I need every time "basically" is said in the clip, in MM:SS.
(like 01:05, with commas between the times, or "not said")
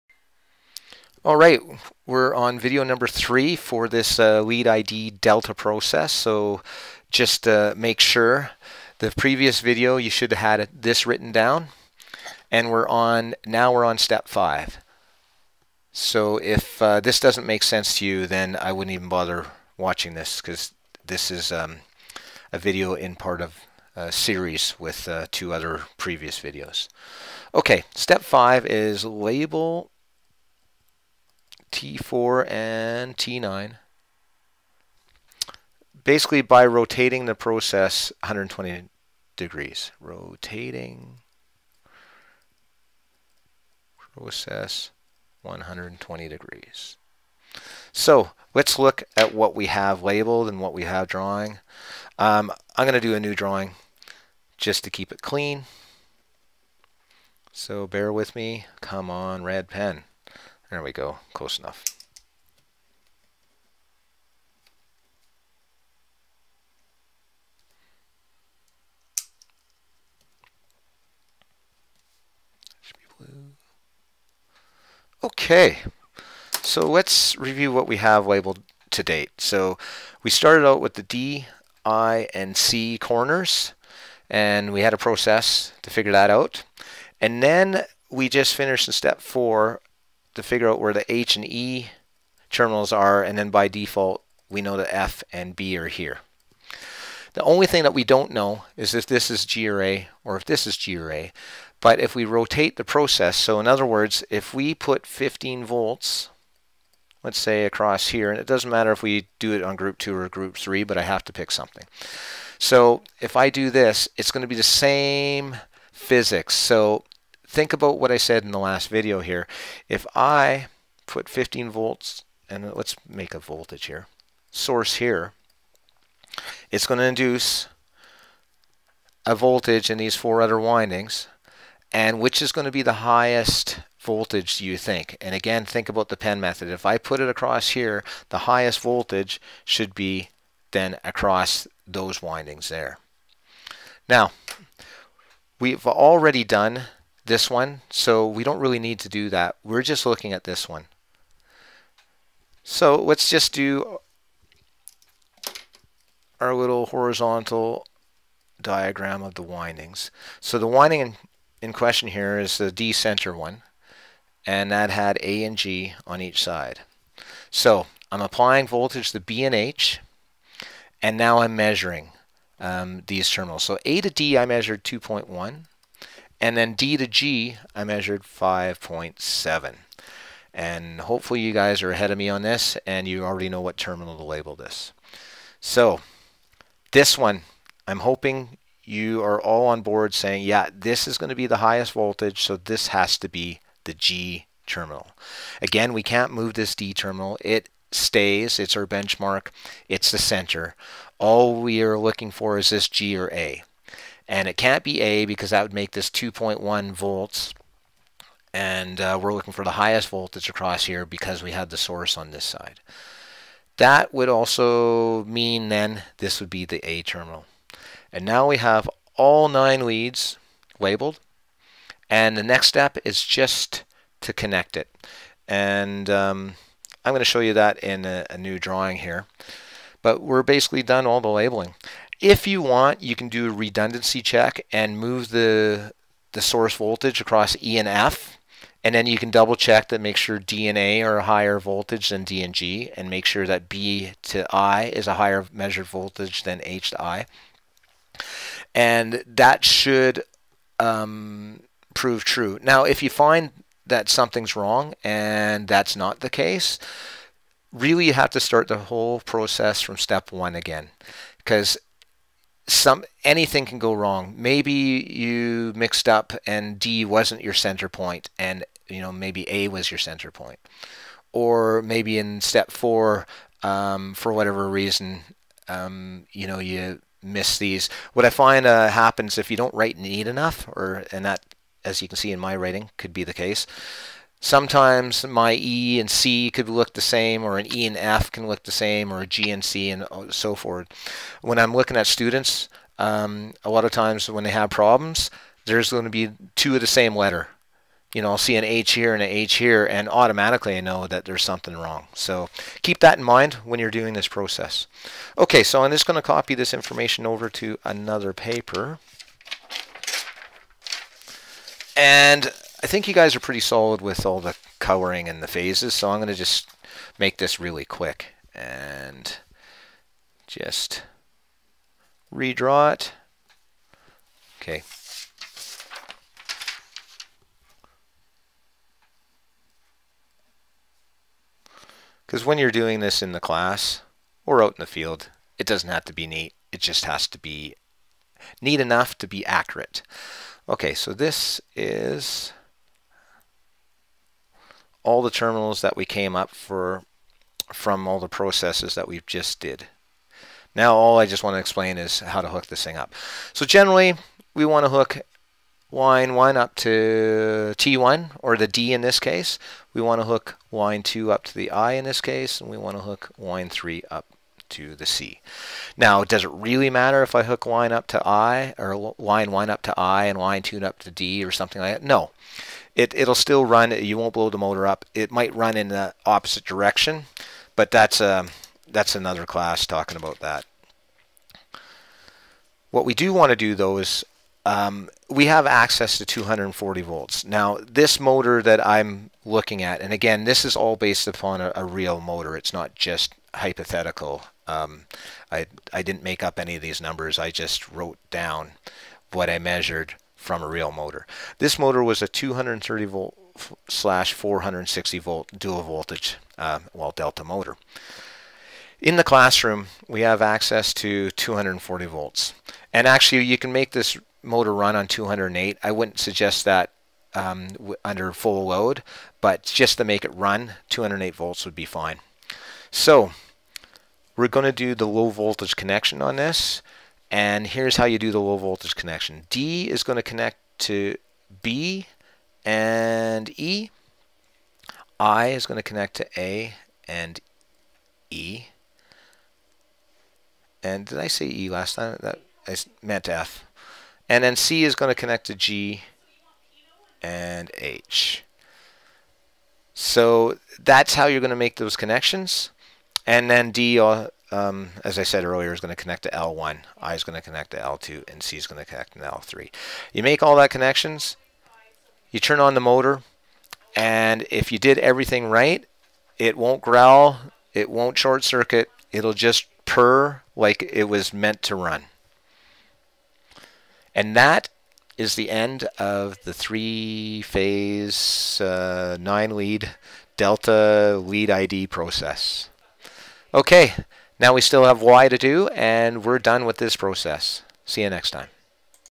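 00:36, 03:50.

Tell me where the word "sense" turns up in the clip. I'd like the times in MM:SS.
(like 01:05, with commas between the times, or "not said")
00:17.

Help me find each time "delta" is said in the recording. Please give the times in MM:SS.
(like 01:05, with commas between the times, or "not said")
00:05, 06:47, 08:00.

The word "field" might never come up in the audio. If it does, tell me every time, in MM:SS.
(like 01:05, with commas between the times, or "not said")
05:34.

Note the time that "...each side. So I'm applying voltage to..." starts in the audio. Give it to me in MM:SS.
02:46.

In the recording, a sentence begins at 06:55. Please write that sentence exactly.
I wouldn't suggest that um, under full load but just to make it run 208 volts would be fine.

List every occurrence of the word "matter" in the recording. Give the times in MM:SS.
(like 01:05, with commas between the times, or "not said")
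01:48, 06:06.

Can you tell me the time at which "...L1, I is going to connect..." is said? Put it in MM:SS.
07:36.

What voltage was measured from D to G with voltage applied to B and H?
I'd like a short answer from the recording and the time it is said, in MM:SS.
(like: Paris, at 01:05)
5.7, at 02:58.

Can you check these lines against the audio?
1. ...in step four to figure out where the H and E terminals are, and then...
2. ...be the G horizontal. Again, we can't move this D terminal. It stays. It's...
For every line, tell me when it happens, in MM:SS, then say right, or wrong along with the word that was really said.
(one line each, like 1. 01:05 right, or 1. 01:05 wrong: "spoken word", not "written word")
1. 01:28 right
2. 03:13 wrong: "terminal", not "horizontal".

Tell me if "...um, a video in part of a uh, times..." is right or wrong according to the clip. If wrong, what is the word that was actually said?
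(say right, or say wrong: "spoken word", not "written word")
wrong: "series", not "times".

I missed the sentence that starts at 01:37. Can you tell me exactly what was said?
The only thing that we don't know is if this is G A, or if this is G A.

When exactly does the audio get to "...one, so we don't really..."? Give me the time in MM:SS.
02:27.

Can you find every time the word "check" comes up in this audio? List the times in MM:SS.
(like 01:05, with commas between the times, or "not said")
03:54, 03:59.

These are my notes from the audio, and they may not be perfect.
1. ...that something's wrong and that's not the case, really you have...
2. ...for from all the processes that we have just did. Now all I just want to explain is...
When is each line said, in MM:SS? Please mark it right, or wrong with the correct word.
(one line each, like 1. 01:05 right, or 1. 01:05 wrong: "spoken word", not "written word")
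1. 04:13 right
2. 05:46 right.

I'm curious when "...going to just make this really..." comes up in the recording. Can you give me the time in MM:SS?
05:16.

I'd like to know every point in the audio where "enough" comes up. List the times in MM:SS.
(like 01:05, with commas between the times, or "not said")
01:01, 04:40, 05:38.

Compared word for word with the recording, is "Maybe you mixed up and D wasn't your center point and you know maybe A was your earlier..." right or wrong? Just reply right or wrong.
wrong.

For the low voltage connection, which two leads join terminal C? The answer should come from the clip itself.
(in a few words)
G and H.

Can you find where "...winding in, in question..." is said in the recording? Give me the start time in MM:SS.
02:40.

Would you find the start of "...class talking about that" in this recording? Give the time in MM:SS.
06:19.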